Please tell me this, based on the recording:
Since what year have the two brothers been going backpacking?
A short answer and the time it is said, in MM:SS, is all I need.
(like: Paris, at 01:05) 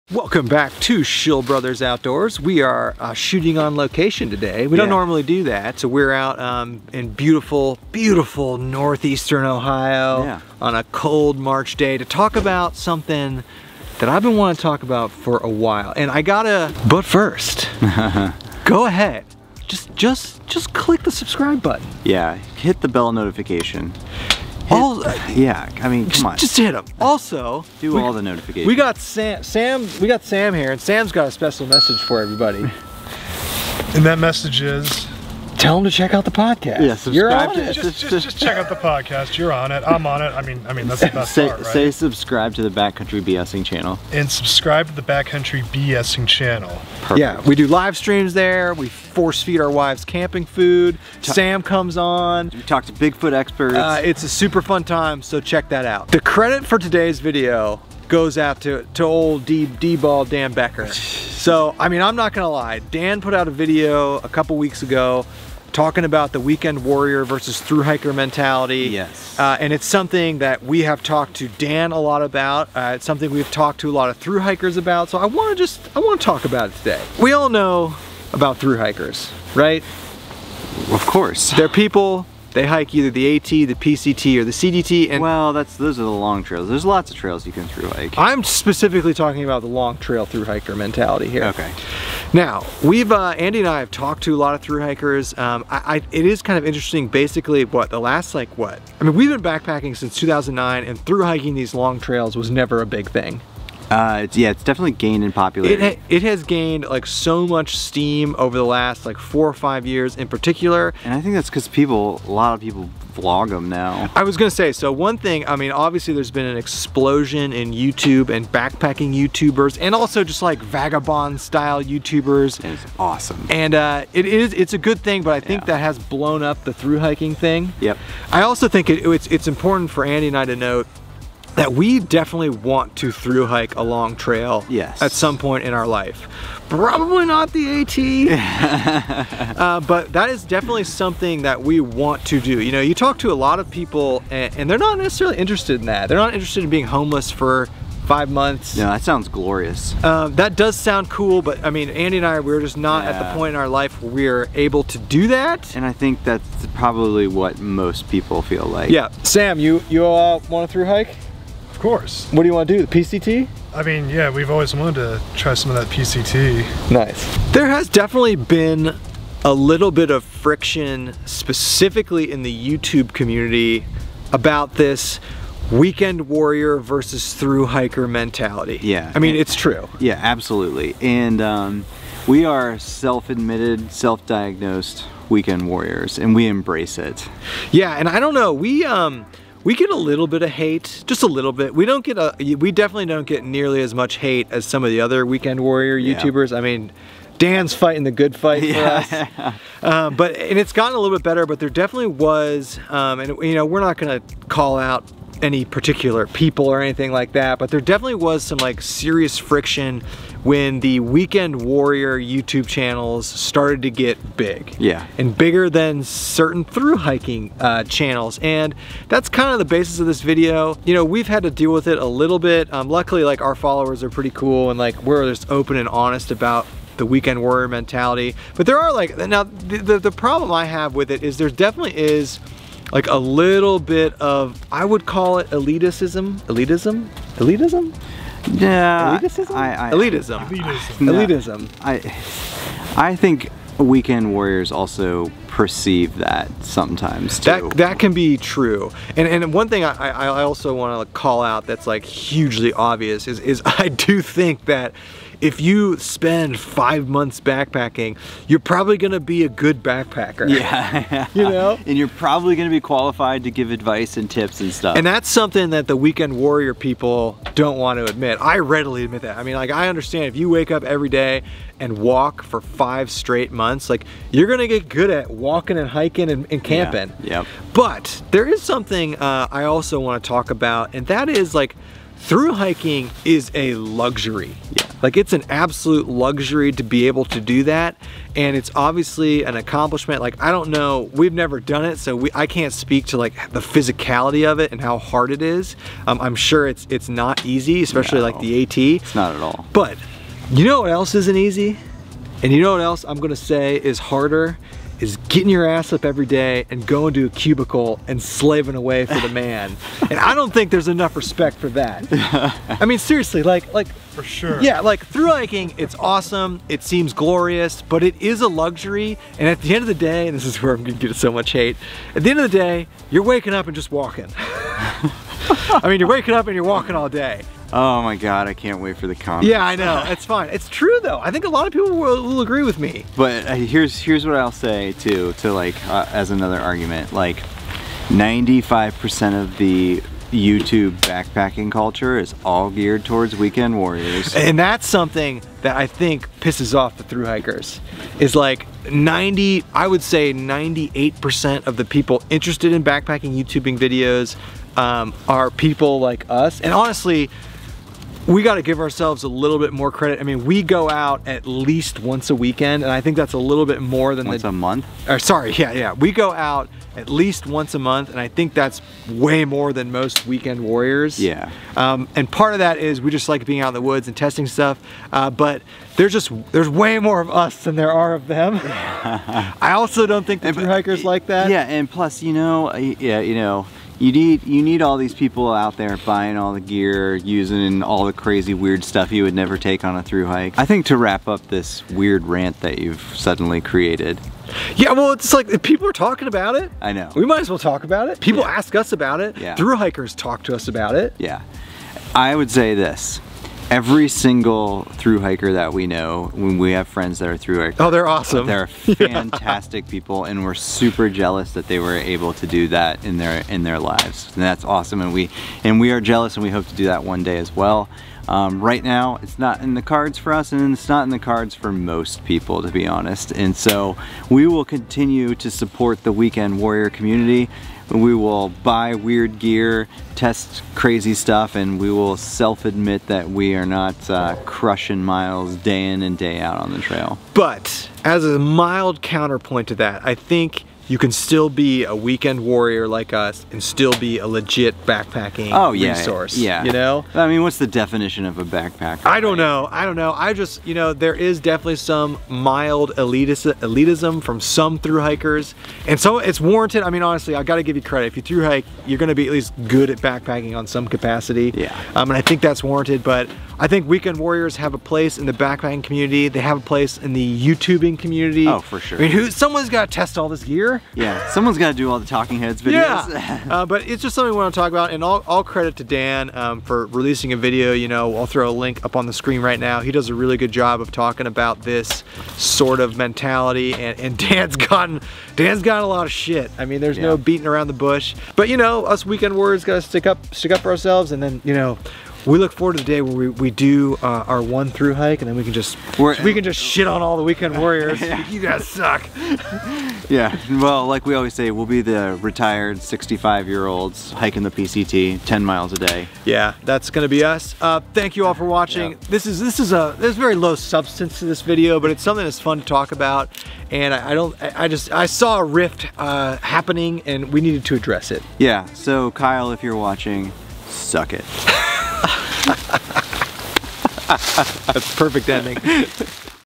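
2009, at 01:40.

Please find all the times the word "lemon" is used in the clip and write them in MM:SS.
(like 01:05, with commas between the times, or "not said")
not said.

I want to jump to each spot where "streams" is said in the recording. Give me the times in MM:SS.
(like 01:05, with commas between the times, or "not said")
00:47.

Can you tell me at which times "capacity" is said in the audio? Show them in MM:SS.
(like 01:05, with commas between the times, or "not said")
07:40.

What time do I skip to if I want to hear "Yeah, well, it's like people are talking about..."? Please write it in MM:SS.
06:34.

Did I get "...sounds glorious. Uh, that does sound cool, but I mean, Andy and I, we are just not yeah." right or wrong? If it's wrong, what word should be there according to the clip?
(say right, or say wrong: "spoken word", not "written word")
right.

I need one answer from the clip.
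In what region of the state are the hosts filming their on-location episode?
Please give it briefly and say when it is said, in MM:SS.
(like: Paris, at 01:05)
northeastern Ohio, at 00:08.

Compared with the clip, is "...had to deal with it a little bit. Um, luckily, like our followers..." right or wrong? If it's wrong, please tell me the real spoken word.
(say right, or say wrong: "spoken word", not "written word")
right.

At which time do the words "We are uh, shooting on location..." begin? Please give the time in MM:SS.
00:02.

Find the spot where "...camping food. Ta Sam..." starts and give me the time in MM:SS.
00:50.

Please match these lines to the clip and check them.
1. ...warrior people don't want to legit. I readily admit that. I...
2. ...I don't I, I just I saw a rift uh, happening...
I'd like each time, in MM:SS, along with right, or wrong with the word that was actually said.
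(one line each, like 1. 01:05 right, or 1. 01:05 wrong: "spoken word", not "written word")
1. 04:26 wrong: "admit", not "legit"
2. 08:34 right.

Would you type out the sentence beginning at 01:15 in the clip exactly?
So I want to just, I want to talk about it today.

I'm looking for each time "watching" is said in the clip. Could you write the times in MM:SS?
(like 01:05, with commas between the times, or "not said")
08:28, 08:39.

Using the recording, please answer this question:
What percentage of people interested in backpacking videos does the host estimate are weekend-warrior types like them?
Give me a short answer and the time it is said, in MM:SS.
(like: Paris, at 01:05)
98%, at 05:50.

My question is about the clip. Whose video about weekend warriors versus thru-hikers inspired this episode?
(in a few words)
Dan Becker.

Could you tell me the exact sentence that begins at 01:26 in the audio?
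There's lots of trails you can through hike.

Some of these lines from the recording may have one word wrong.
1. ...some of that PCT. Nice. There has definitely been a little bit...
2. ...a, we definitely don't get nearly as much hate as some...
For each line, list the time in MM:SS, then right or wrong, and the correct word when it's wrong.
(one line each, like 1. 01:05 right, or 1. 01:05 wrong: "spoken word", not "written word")
1. 02:45 right
2. 03:12 right.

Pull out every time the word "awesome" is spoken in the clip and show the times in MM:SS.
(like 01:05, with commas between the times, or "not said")
02:02, 05:15, 06:48, 06:54.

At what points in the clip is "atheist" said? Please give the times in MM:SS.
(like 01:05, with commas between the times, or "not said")
not said.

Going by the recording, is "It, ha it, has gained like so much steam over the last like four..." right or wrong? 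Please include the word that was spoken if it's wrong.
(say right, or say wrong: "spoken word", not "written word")
right.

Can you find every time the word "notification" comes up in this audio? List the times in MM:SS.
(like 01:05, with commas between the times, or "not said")
00:23, 00:28.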